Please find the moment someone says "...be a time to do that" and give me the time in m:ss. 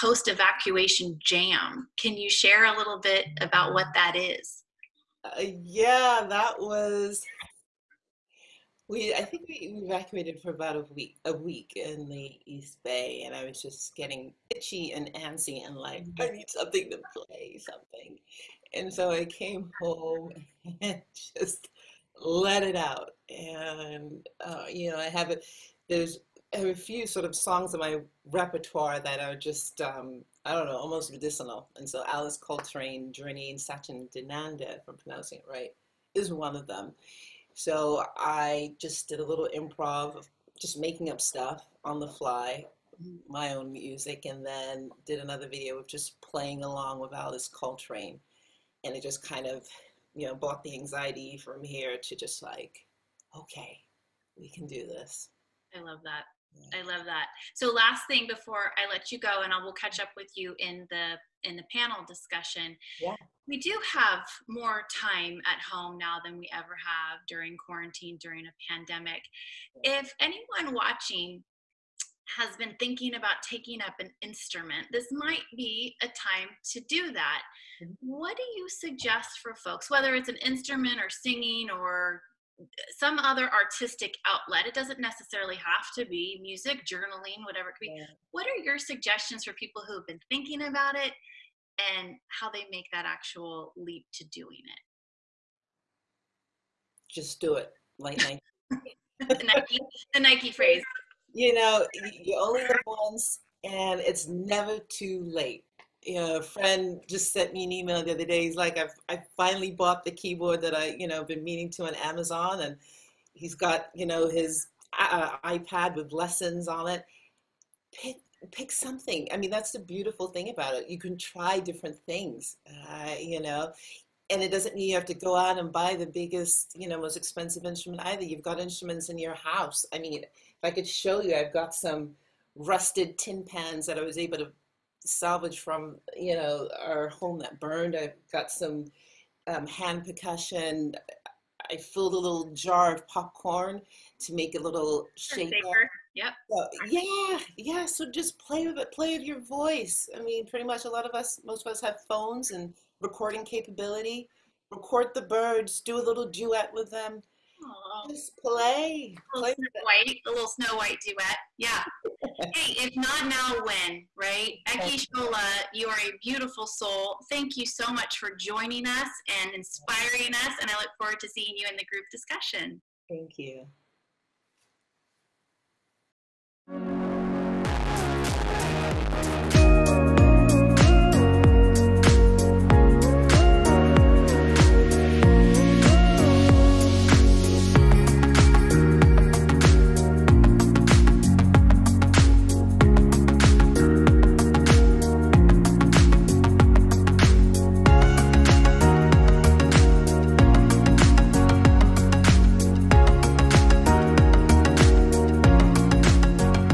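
1:15.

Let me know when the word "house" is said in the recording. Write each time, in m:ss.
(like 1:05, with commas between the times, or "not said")
2:09.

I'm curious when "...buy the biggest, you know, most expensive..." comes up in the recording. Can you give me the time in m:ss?
2:05.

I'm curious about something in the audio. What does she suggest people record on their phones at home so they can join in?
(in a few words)
Birds.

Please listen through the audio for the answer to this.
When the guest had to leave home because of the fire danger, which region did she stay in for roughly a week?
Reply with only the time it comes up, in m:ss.
0:12.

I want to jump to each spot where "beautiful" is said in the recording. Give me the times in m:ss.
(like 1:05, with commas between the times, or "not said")
1:59, 2:46.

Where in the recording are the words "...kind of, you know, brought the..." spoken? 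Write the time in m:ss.
0:49.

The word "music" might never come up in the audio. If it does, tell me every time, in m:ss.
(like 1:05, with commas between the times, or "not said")
0:43, 1:26.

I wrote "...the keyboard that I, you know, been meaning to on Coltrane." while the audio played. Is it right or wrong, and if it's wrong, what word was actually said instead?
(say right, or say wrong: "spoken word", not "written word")
wrong: "Amazon", not "Coltrane".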